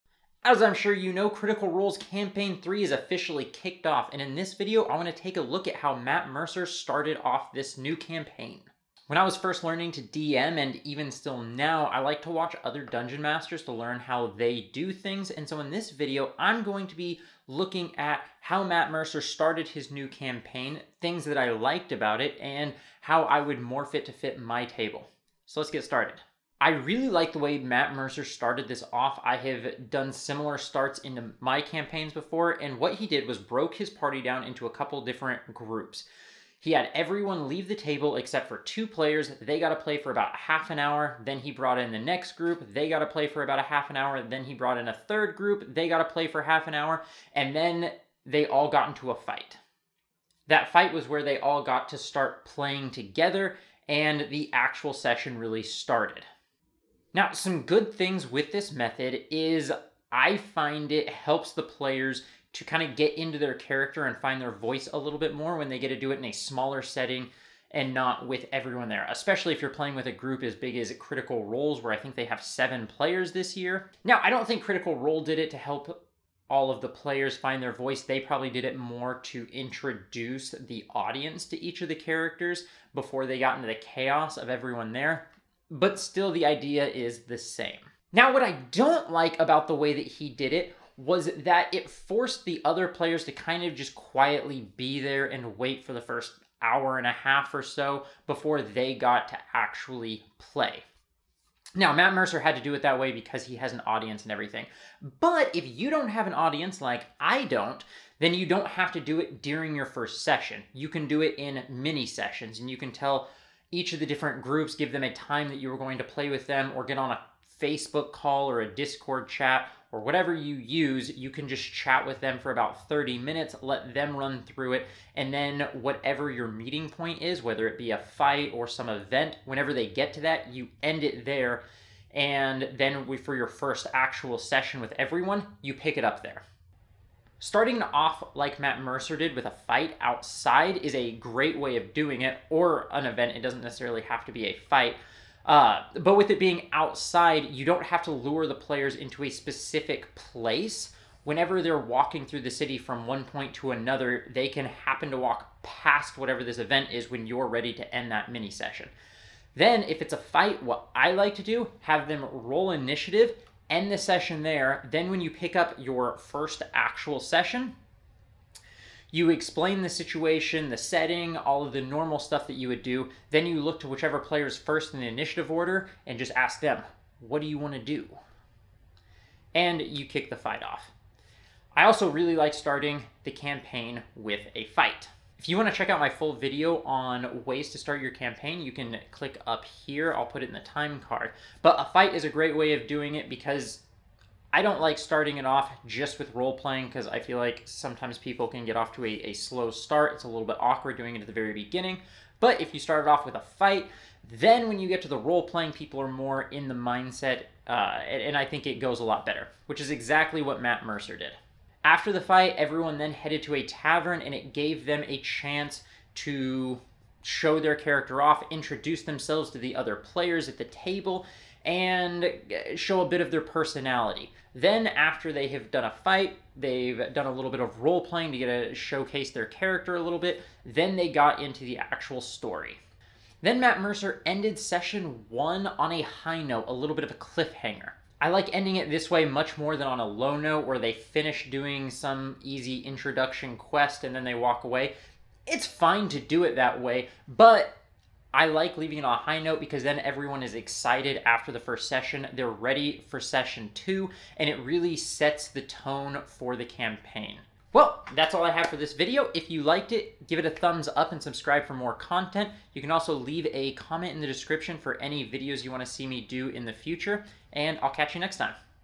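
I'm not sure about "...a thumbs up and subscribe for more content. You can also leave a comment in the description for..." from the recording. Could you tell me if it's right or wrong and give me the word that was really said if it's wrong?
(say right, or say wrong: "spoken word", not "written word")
right.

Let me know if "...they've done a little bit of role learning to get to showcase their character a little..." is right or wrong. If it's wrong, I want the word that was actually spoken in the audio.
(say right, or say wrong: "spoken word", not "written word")
wrong: "playing", not "learning".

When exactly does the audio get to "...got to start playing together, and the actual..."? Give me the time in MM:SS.
00:51.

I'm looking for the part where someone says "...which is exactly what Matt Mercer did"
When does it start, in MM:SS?
03:29.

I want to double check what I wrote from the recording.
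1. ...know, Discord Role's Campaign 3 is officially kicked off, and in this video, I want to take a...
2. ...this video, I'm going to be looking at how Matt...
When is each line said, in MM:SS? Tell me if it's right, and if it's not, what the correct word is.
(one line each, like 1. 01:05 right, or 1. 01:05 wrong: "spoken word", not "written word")
1. 00:01 wrong: "Critical", not "Discord"
2. 00:15 right.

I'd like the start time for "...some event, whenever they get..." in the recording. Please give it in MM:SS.
02:08.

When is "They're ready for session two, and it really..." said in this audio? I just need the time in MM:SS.
04:12.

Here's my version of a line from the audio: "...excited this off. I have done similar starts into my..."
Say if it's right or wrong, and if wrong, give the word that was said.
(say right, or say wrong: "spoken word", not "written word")
wrong: "started", not "excited".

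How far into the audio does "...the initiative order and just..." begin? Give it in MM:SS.
02:54.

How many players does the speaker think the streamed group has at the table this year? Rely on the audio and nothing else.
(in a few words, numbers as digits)
7.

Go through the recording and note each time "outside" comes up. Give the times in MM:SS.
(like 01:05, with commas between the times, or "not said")
02:19, 02:26.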